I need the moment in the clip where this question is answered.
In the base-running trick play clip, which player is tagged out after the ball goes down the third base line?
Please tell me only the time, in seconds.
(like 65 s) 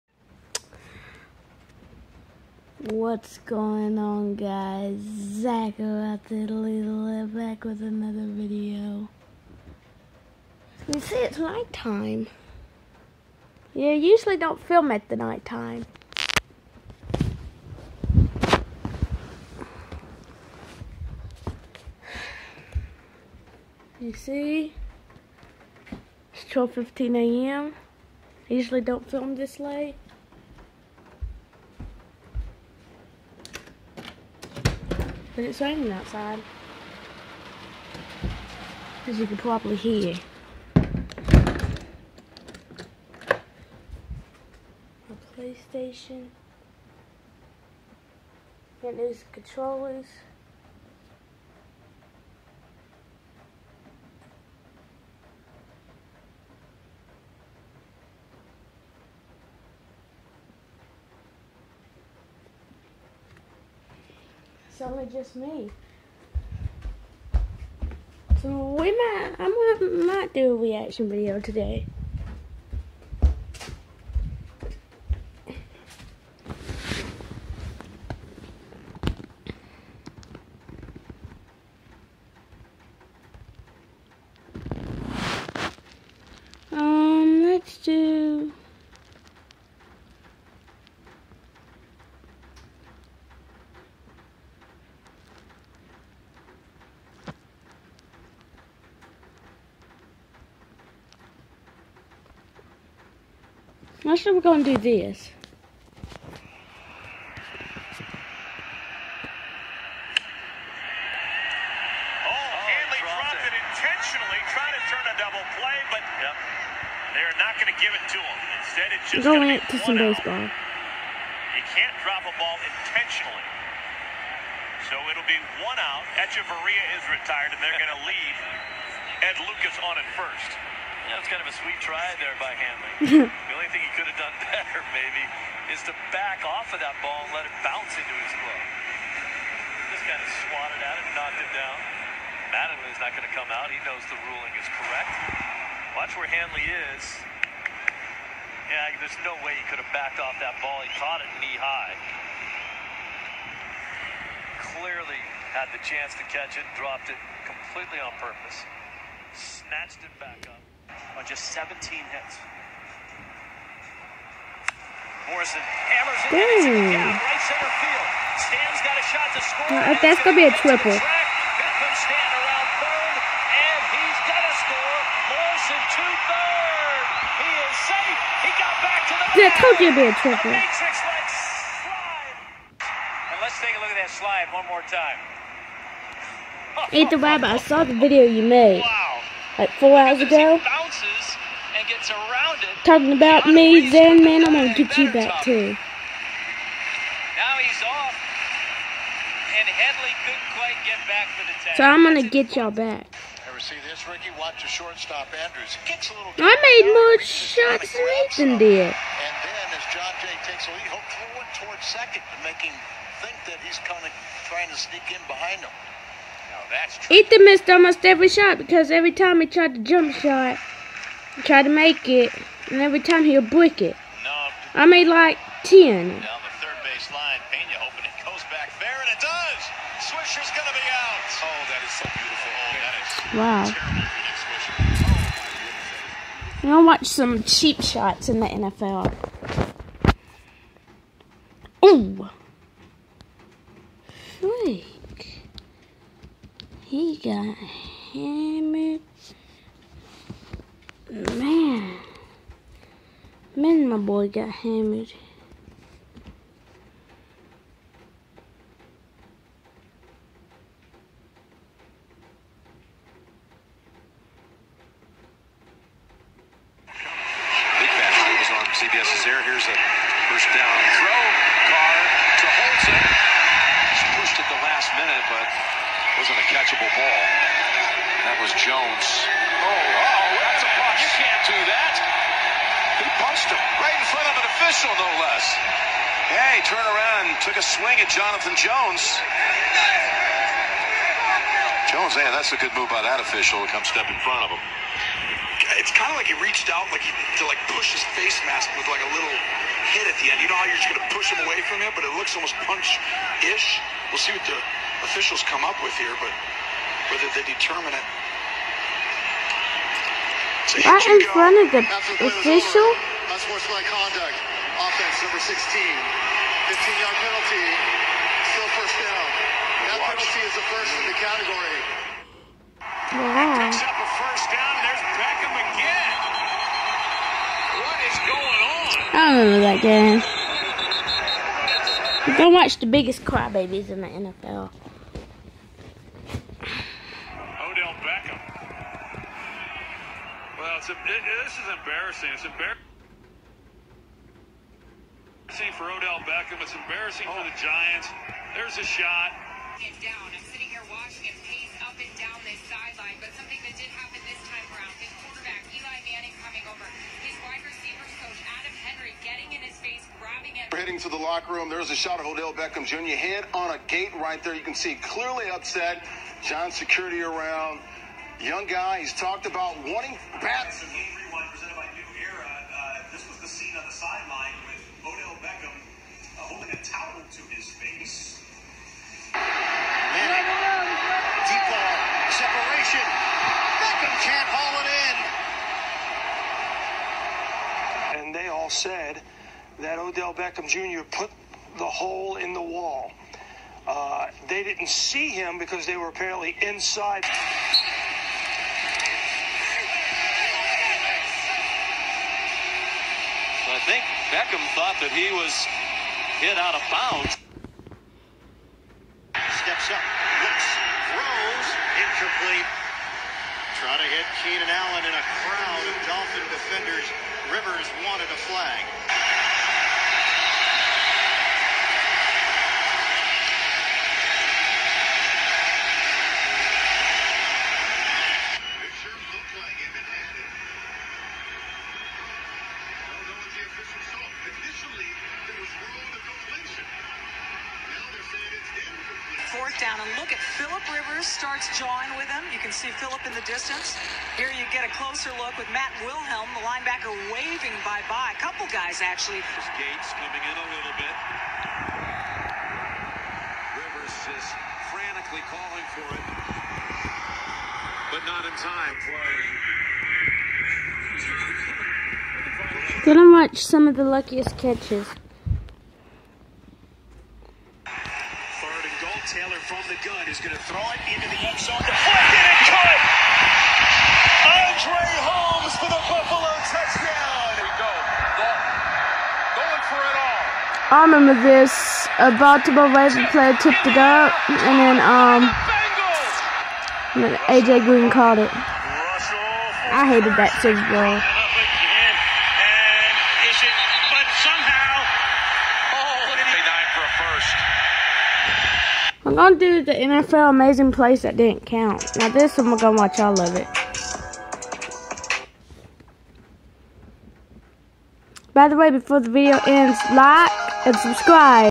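230 s.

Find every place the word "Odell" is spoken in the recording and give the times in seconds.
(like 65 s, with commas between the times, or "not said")
337 s, 345 s, 362 s, 375 s, 389 s.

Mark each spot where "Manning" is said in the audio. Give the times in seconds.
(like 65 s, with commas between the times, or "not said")
356 s, 379 s.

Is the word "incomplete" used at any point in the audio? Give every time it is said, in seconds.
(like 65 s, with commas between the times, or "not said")
412 s.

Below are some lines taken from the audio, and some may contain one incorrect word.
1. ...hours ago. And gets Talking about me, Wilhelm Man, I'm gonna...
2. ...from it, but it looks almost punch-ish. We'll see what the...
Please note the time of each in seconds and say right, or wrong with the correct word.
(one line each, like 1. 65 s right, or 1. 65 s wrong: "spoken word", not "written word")
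1. 189 s wrong: "Zen", not "Wilhelm"
2. 301 s right.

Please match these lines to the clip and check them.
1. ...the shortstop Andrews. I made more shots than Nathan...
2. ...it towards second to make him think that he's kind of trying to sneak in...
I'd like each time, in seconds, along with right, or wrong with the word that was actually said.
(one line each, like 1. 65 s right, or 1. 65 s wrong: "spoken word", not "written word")
1. 204 s right
2. 211 s right.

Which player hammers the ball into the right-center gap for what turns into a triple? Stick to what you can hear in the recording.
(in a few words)
Morrison.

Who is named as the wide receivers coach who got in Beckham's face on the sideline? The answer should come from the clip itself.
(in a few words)
Adam Henry.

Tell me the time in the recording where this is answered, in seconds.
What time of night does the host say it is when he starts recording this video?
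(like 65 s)
26 s.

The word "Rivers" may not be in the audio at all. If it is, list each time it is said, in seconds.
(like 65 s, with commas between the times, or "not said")
417 s, 440 s, 453 s.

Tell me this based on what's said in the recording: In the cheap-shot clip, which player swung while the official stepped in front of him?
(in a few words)
Jonathan Jones.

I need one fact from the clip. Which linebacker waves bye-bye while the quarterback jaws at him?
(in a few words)
Matt Wilhelm.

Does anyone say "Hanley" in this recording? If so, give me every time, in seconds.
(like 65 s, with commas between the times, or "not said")
132 s, 146 s.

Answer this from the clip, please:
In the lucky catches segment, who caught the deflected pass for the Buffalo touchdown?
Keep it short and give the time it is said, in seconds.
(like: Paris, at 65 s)
Andre Holmes, at 474 s.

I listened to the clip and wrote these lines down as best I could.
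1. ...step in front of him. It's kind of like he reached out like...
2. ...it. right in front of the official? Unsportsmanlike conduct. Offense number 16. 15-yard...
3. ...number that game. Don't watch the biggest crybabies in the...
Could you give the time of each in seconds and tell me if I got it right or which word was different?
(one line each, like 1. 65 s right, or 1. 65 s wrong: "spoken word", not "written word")
1. 293 s right
2. 307 s right
3. 329 s wrong: "remember", not "number".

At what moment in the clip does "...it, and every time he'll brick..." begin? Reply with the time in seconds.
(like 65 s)
222 s.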